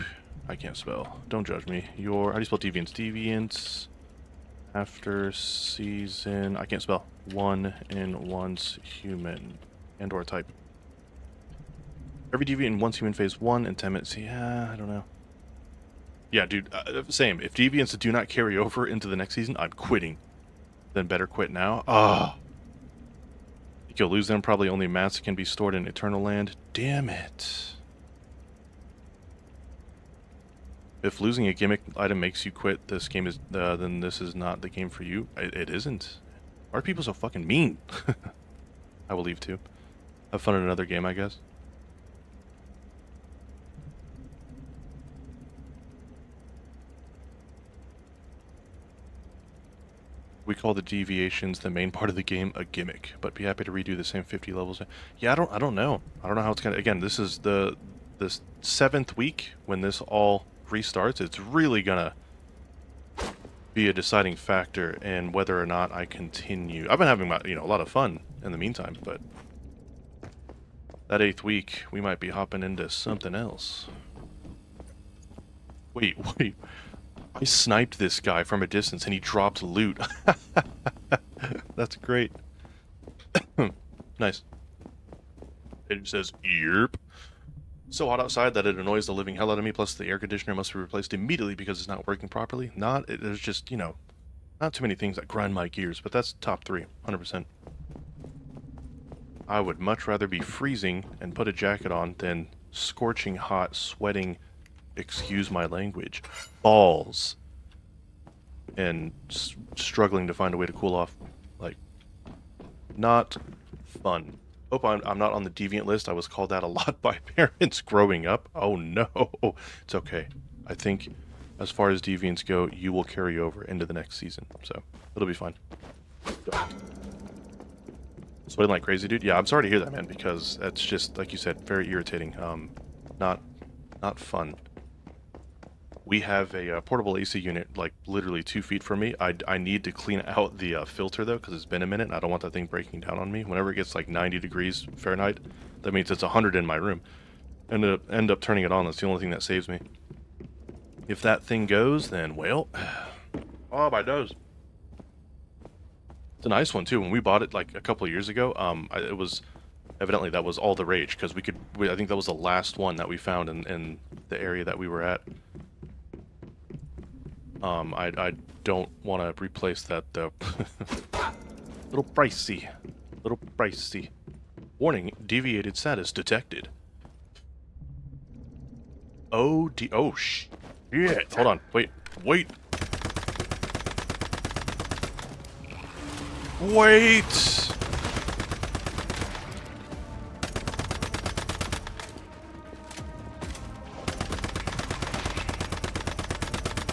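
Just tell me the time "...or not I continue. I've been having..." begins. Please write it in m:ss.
1:05.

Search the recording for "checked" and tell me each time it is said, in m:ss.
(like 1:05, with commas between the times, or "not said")
not said.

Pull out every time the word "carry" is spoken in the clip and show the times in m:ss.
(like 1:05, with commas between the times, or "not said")
0:18, 2:03.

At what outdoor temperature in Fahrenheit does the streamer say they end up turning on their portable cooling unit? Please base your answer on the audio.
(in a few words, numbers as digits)
90 degrees.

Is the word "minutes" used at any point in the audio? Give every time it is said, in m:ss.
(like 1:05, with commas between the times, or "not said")
0:13, 2:21.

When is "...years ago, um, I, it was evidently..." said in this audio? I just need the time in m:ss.
2:38.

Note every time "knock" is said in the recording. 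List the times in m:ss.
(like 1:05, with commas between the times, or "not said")
not said.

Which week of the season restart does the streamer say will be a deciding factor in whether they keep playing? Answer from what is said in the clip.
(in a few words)
seventh week.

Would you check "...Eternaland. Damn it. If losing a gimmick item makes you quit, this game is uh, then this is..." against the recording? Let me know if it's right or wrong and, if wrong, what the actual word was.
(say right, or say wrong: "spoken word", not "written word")
right.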